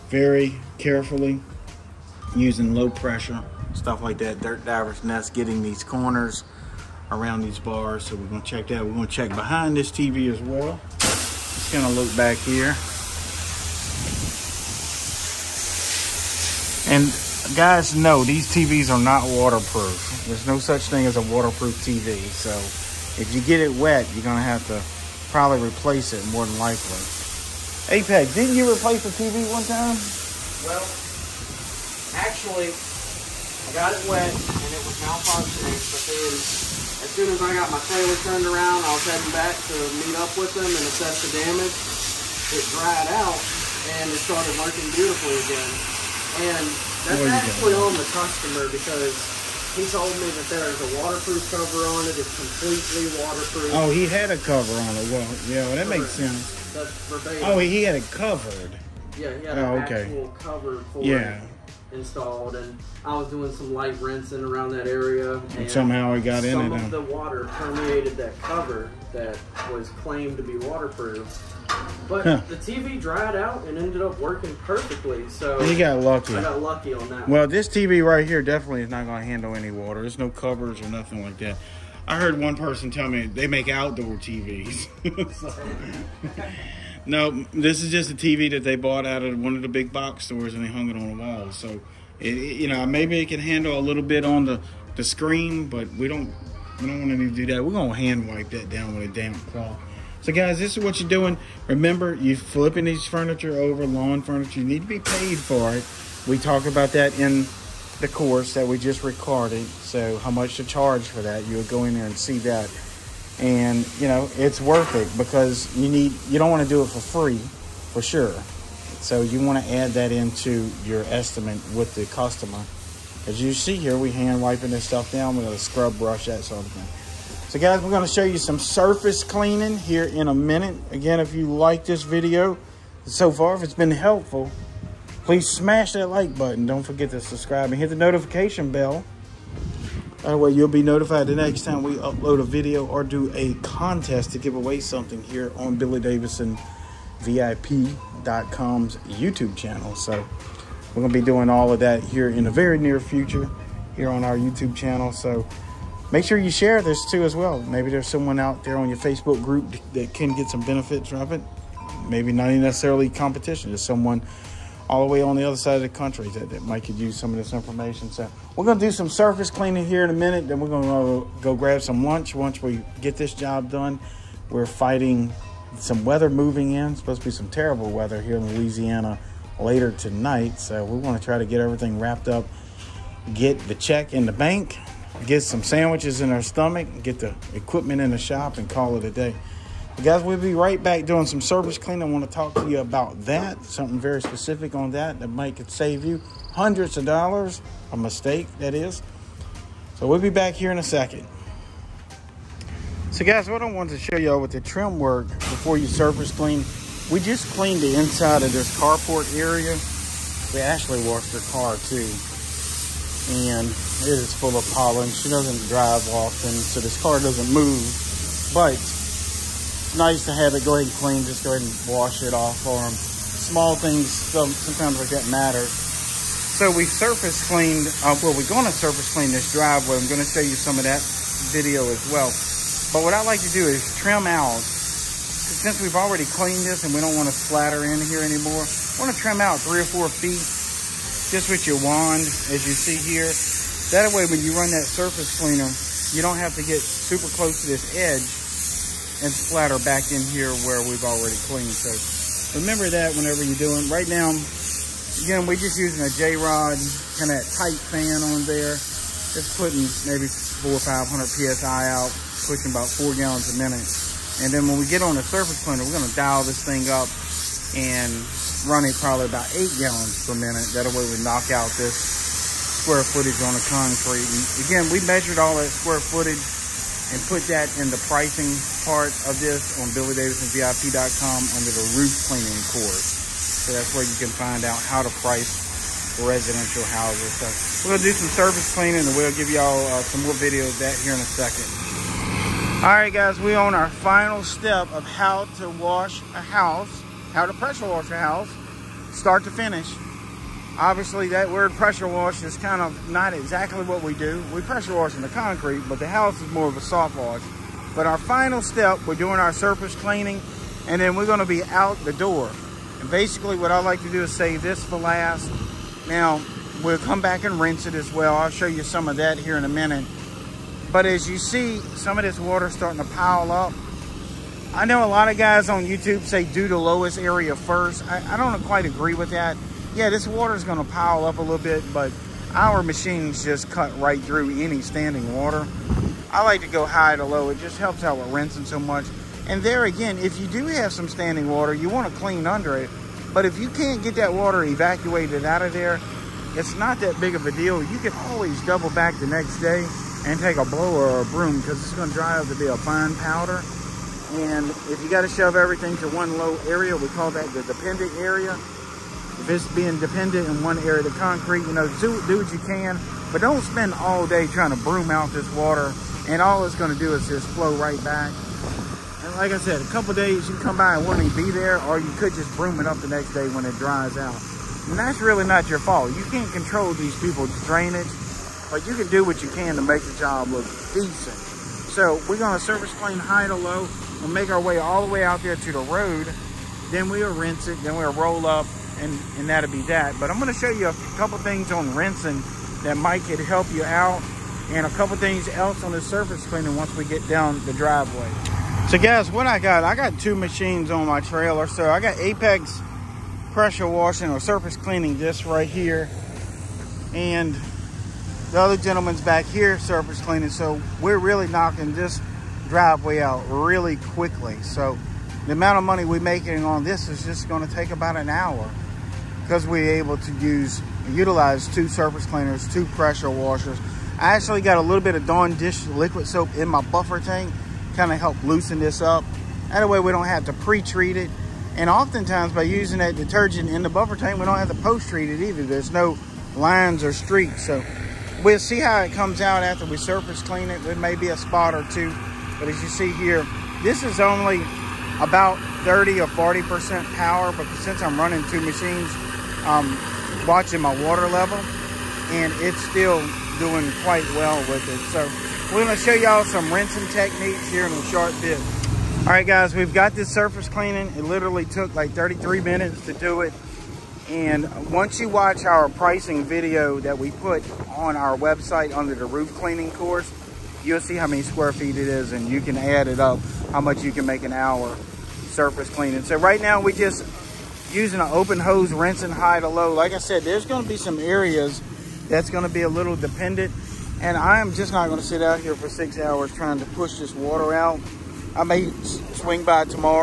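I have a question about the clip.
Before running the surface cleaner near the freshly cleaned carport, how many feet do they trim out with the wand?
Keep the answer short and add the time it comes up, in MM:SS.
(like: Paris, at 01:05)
3 or 4 feet, at 03:59.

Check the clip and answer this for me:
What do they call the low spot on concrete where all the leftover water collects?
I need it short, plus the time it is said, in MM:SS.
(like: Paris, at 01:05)
dependent area, at 05:57.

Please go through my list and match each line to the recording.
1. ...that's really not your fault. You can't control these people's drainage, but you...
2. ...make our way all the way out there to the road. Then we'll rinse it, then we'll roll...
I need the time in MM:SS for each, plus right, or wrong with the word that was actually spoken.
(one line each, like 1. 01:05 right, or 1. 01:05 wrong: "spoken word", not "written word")
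1. 06:14 right
2. 06:24 right.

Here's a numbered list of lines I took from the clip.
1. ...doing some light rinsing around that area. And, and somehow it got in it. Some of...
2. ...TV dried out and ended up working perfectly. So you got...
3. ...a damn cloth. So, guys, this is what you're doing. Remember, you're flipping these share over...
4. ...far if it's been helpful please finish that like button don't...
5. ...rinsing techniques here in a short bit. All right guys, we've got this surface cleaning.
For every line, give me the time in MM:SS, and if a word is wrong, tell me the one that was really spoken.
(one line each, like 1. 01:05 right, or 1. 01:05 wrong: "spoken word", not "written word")
1. 01:03 right
2. 01:12 right
3. 01:39 wrong: "furniture", not "share"
4. 02:13 wrong: "smash", not "finish"
5. 07:36 right.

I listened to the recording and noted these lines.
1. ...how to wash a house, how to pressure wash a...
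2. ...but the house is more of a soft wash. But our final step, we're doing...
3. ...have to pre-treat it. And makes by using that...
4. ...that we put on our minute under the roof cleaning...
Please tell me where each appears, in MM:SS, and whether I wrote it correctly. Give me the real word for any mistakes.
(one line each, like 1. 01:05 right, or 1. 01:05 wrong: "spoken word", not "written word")
1. 04:55 right
2. 05:05 right
3. 07:10 wrong: "oftentimes", not "makes"
4. 07:46 wrong: "website", not "minute".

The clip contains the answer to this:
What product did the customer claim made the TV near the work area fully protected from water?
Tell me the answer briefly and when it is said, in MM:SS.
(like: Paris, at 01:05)
waterproof cover, at 00:50.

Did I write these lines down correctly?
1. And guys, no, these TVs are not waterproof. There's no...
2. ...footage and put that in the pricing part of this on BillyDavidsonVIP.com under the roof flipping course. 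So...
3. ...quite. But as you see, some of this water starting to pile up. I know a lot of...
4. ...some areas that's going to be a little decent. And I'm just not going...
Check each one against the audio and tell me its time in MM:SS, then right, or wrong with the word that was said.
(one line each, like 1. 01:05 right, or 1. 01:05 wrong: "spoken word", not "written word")
1. 00:16 right
2. 04:36 wrong: "cleaning", not "flipping"
3. 05:19 wrong: "minute", not "quite"
4. 08:00 wrong: "dependent", not "decent".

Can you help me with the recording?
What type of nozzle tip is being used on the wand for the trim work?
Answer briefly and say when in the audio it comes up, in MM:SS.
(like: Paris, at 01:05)
J-Rod, at 04:16.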